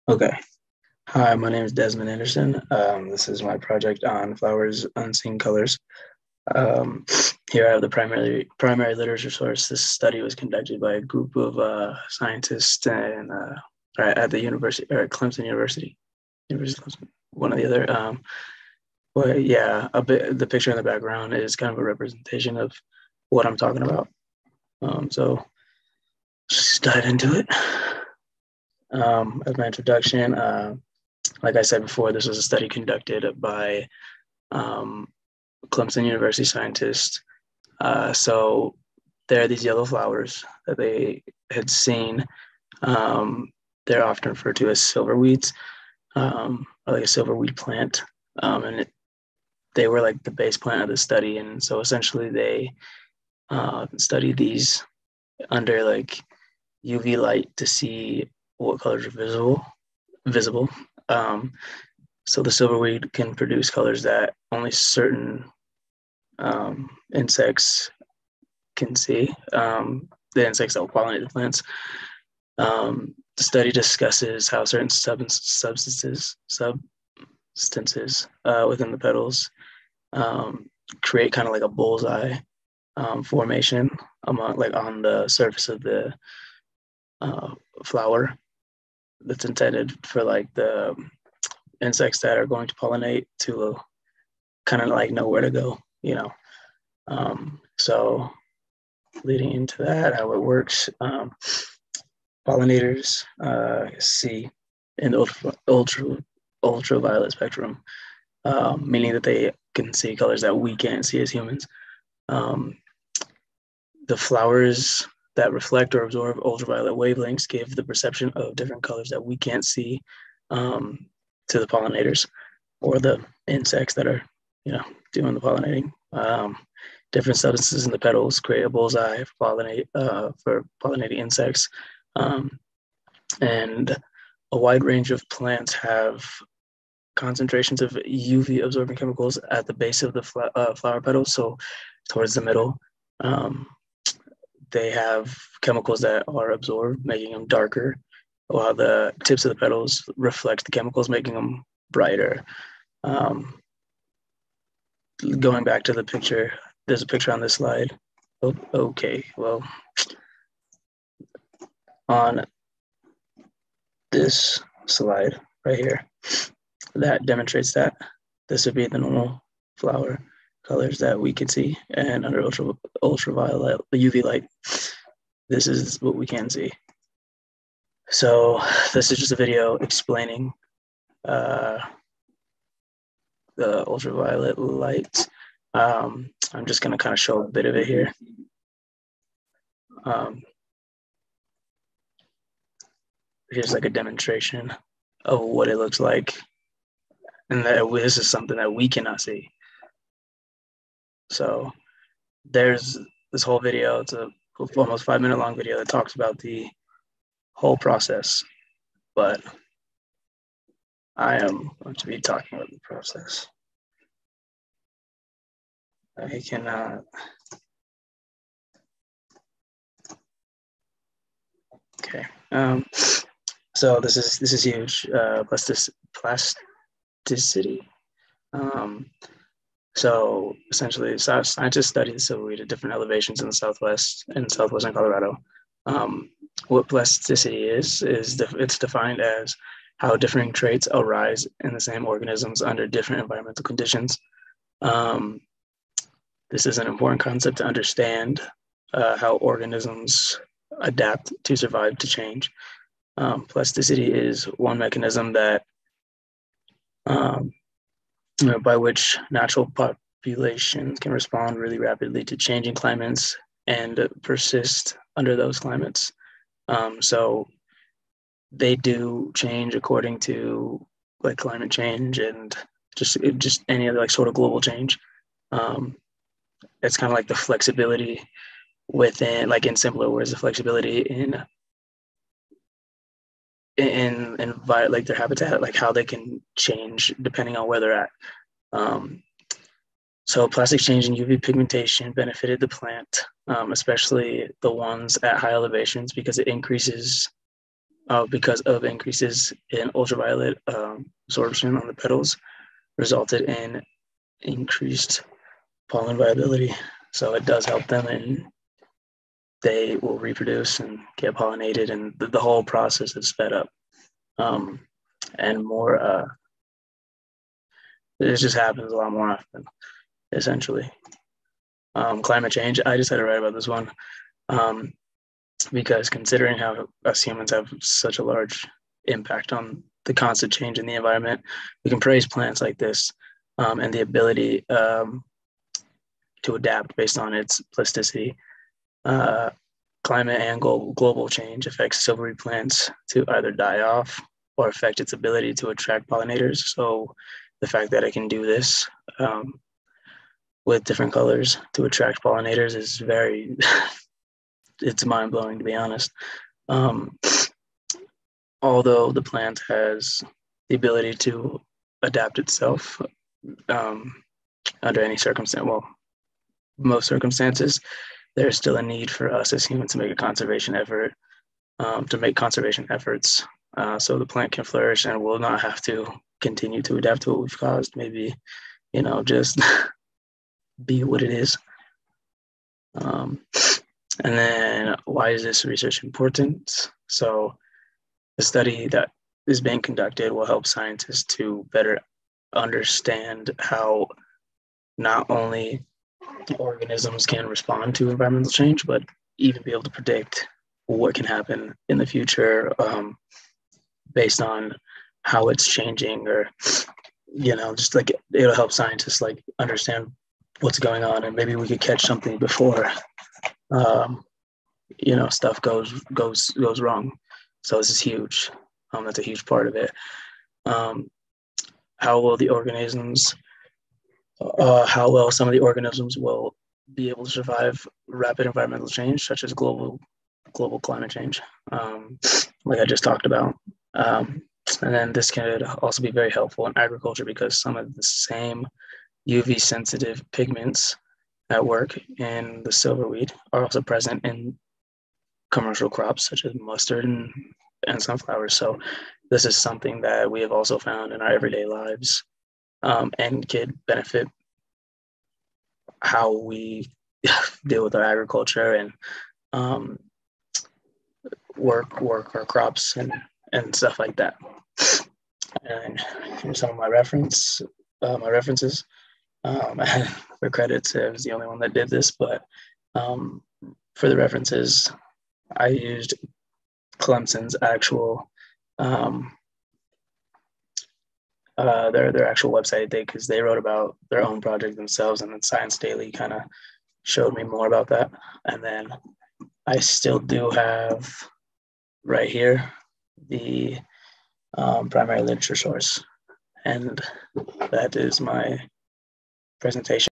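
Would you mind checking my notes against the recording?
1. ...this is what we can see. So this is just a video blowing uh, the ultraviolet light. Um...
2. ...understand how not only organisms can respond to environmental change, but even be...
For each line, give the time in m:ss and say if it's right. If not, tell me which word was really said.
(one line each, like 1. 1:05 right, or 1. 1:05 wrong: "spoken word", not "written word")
1. 2:55 wrong: "explaining", not "blowing"
2. 6:32 right.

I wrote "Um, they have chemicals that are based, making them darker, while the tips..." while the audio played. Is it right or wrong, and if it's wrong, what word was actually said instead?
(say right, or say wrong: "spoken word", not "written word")
wrong: "absorbed", not "based".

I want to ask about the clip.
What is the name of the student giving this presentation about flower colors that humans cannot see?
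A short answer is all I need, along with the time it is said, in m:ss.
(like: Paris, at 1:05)
Desmond Anderson, at 0:01.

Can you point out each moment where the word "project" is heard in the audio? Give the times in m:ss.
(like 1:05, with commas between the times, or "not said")
0:03, 8:04.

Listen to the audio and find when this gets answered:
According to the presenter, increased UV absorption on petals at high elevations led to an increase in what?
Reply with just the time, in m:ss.
5:05.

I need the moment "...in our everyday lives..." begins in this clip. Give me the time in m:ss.
7:31.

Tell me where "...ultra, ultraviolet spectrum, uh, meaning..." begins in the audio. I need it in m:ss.
1:45.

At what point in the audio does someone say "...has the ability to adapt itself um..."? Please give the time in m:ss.
5:59.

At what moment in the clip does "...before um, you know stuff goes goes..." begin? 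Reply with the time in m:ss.
6:52.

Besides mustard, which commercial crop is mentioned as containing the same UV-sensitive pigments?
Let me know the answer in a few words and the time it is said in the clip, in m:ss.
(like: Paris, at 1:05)
sunflowers, at 7:28.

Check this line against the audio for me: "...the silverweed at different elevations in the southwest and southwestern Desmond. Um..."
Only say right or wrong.
wrong.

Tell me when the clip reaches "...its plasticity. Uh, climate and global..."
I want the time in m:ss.
5:37.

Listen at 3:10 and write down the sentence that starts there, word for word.
Um, here's like a demonstration of what it looks like.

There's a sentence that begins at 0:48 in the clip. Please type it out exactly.
Um, and it, they were like the base plant of the study.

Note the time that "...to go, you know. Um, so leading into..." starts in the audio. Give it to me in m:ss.
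1:35.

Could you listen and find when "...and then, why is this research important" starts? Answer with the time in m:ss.
6:24.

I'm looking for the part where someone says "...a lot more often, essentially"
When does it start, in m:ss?
5:18.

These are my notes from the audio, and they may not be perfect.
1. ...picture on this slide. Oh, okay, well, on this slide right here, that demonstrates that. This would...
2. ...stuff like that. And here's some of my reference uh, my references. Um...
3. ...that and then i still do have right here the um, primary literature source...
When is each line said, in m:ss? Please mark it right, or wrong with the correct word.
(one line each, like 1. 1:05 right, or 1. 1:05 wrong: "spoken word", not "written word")
1. 2:37 right
2. 7:43 right
3. 8:07 right.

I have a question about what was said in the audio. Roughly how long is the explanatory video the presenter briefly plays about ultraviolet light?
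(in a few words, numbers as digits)
almost 5 minutes.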